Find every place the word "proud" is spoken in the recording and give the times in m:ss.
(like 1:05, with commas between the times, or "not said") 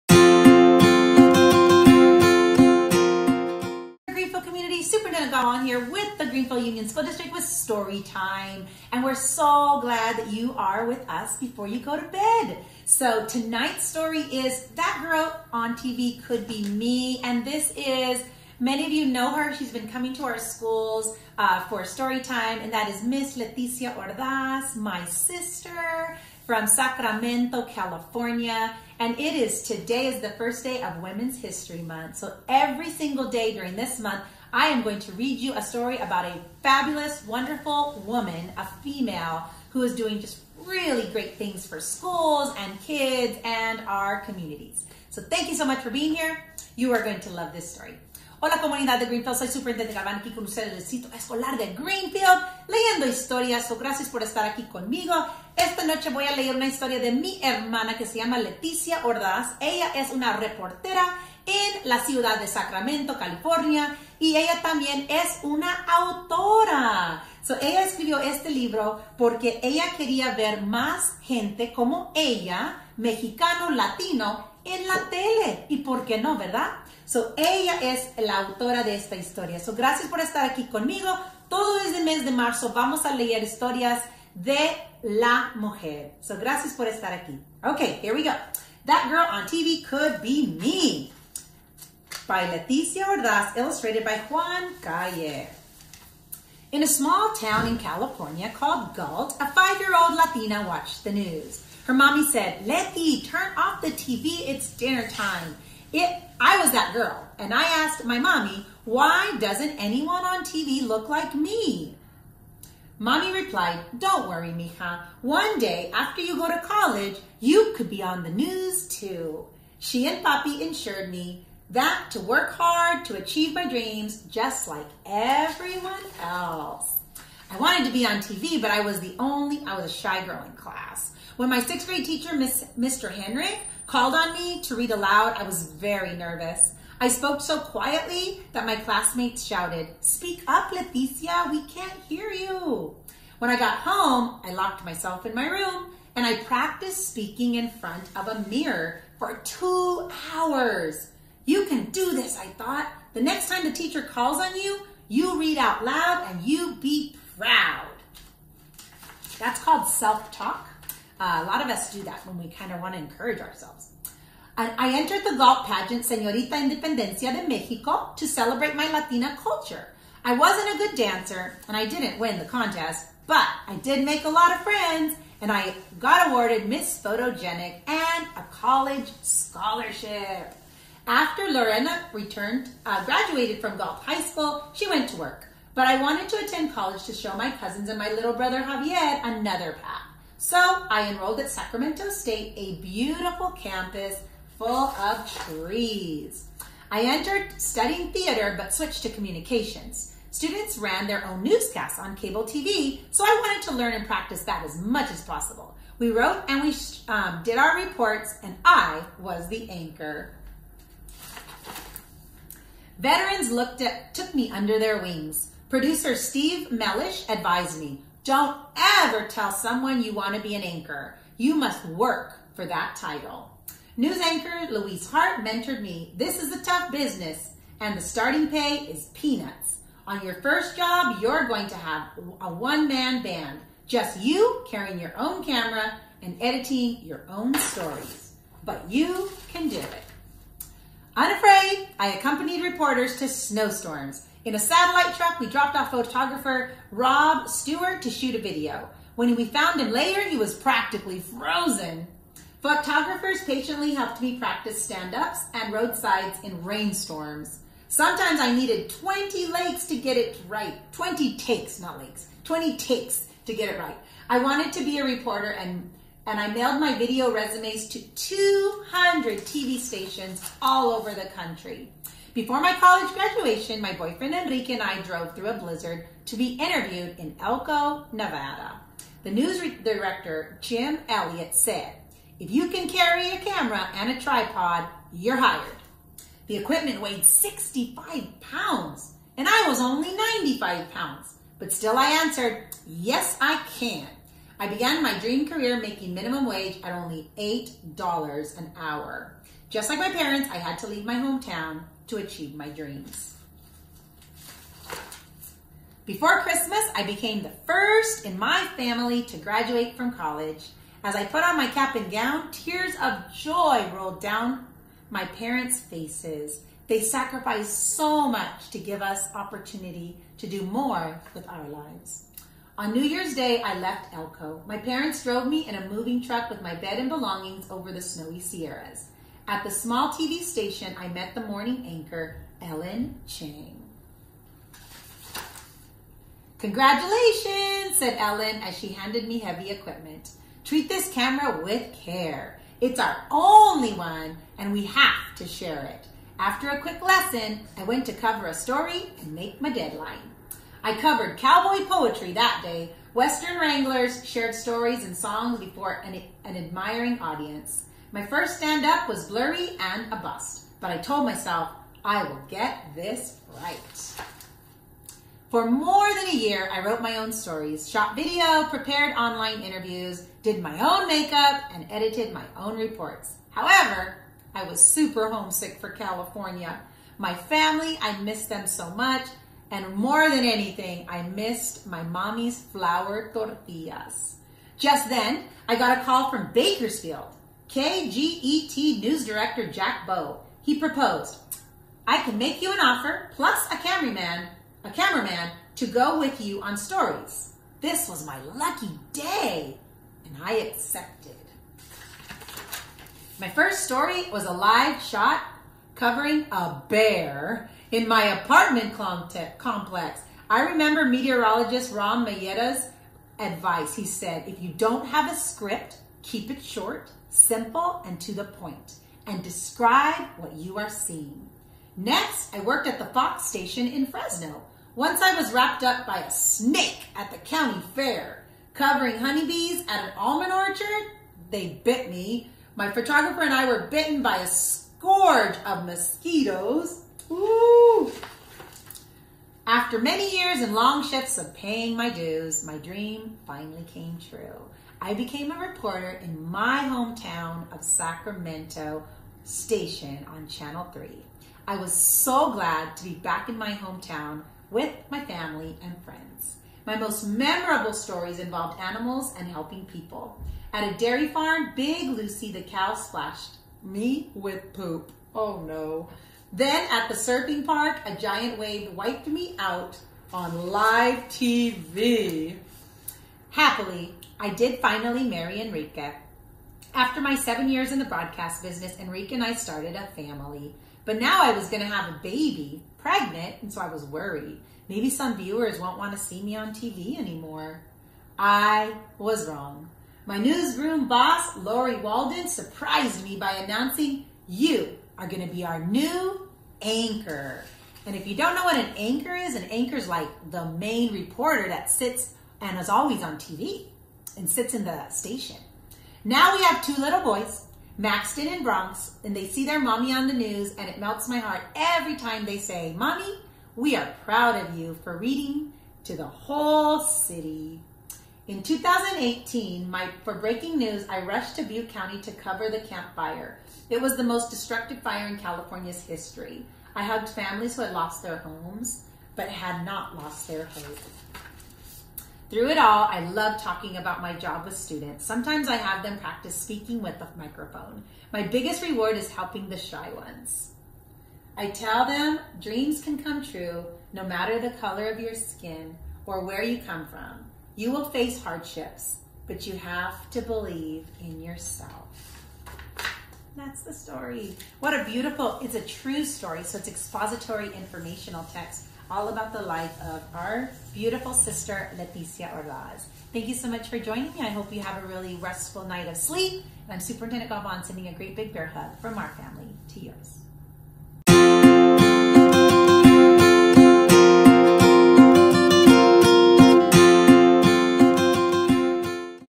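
2:37, 8:34.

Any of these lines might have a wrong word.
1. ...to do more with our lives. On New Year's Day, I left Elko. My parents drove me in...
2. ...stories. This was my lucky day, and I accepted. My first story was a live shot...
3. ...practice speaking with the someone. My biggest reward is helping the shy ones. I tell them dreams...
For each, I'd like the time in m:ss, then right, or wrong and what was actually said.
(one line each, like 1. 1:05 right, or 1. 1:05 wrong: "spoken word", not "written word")
1. 5:20 right
2. 6:36 right
3. 8:56 wrong: "microphone", not "someone".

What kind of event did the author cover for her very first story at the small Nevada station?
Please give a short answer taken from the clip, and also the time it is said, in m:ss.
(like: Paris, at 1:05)
cowboy poetry, at 5:51.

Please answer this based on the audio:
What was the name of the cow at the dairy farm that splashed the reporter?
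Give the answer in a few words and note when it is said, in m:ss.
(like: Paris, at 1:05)
Big Lucy, at 7:41.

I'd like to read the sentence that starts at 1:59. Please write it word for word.
She and Papi insured me that to work hard to achieve my dreams just like everyone else.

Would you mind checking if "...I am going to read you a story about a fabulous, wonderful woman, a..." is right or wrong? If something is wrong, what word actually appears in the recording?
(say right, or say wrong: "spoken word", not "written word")
right.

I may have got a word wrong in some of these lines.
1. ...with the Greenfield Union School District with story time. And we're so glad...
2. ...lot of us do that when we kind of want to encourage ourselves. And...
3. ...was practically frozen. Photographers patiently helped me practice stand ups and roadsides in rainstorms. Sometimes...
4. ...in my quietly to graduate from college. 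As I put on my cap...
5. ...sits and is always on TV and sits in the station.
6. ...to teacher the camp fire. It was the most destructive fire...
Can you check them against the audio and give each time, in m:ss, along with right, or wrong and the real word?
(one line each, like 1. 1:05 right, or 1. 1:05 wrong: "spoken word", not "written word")
1. 0:05 right
2. 2:41 right
3. 4:10 right
4. 5:08 wrong: "family", not "quietly"
5. 8:21 right
6. 8:42 wrong: "cover", not "teacher".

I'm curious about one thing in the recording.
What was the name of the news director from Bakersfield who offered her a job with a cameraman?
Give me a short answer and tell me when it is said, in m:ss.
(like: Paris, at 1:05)
Jack Bow, at 6:29.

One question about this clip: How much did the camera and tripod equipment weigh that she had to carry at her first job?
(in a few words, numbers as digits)
65 pounds.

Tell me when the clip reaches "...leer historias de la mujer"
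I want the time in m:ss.
1:23.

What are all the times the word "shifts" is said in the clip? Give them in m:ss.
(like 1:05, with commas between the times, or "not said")
7:21.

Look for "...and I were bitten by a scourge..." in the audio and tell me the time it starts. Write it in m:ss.
7:13.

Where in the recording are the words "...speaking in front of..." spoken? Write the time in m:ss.
2:27.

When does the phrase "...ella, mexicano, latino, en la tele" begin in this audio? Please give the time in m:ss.
1:12.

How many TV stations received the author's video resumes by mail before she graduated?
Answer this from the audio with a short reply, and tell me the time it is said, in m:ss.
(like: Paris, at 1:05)
200, at 4:28.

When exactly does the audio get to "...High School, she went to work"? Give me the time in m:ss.
3:04.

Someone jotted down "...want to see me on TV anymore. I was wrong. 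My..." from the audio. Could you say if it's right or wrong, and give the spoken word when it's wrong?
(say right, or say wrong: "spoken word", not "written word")
right.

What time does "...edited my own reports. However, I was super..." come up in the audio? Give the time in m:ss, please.
6:11.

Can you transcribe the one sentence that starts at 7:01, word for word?
Next, I worked at the Fox station in Fresno.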